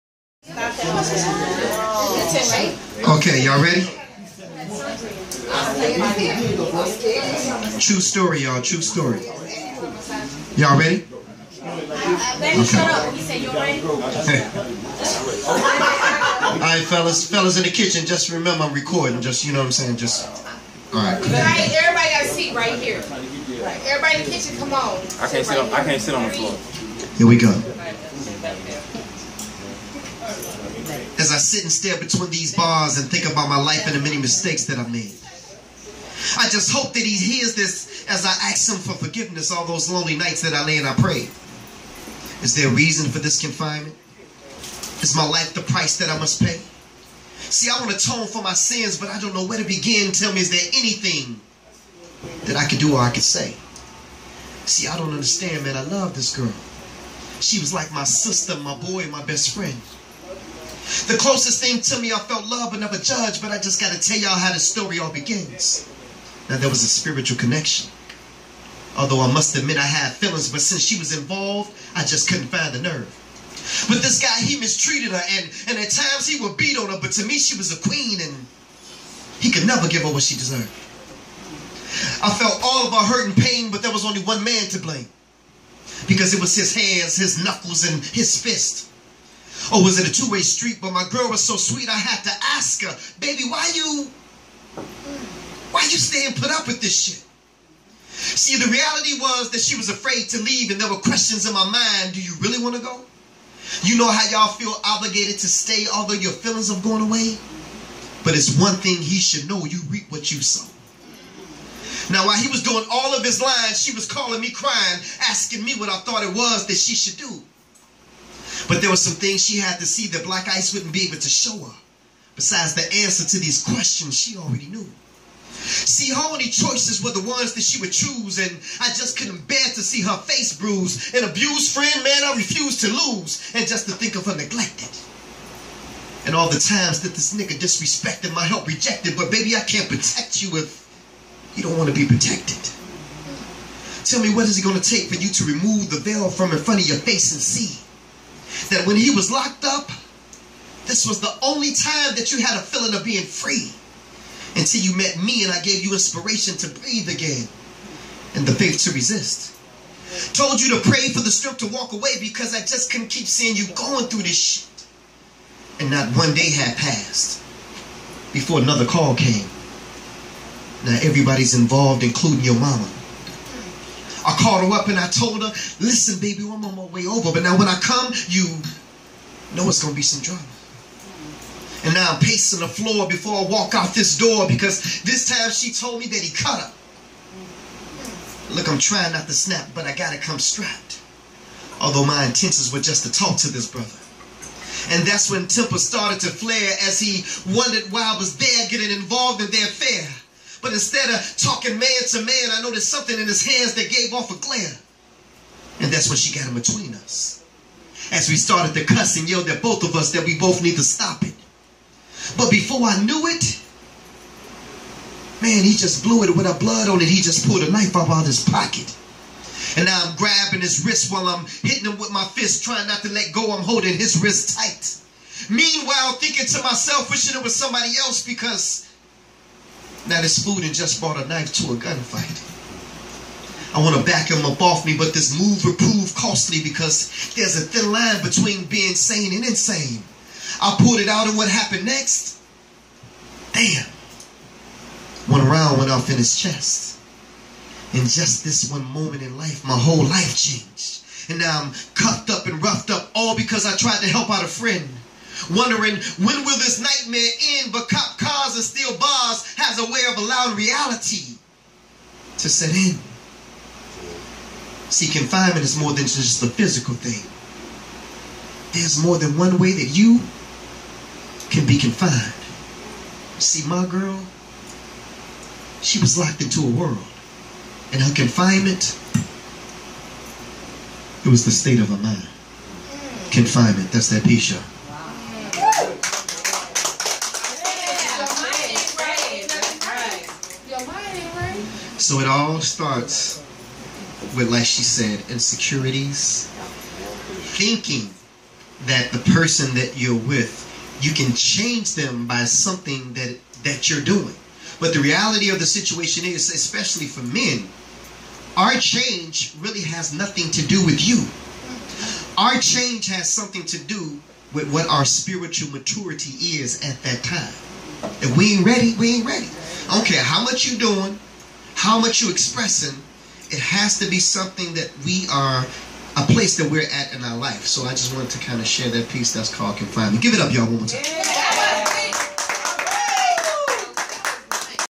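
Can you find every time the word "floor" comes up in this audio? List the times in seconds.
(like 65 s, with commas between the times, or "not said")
26 s, 182 s.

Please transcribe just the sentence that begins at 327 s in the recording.
So I just wanted to kind of share that piece that's called Confinement.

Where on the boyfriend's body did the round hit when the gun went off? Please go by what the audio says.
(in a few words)
his chest.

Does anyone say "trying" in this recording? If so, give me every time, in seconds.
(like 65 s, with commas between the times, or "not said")
188 s, 222 s.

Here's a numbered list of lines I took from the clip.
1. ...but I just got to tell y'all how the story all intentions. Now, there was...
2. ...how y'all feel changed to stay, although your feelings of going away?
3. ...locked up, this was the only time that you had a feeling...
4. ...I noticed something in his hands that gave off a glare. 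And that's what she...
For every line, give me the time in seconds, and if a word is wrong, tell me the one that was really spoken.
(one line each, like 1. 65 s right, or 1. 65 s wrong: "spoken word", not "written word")
1. 63 s wrong: "begins", not "intentions"
2. 104 s wrong: "obligated", not "changed"
3. 149 s right
4. 202 s right.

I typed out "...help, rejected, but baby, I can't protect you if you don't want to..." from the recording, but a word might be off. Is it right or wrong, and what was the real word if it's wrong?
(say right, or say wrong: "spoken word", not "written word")
right.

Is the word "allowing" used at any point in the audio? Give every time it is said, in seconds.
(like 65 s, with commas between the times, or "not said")
260 s.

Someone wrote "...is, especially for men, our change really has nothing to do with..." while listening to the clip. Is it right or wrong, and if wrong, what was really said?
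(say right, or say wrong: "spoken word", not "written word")
right.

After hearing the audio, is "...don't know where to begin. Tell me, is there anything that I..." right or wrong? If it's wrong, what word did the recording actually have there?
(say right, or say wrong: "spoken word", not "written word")
right.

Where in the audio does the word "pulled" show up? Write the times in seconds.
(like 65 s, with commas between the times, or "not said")
217 s, 240 s.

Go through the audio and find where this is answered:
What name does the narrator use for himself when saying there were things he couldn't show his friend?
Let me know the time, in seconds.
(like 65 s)
120 s.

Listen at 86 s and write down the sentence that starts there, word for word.
Because it was his hands, his knuckles, and his fist or oh, was it a two-way street?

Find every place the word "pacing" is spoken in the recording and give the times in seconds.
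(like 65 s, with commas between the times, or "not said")
182 s.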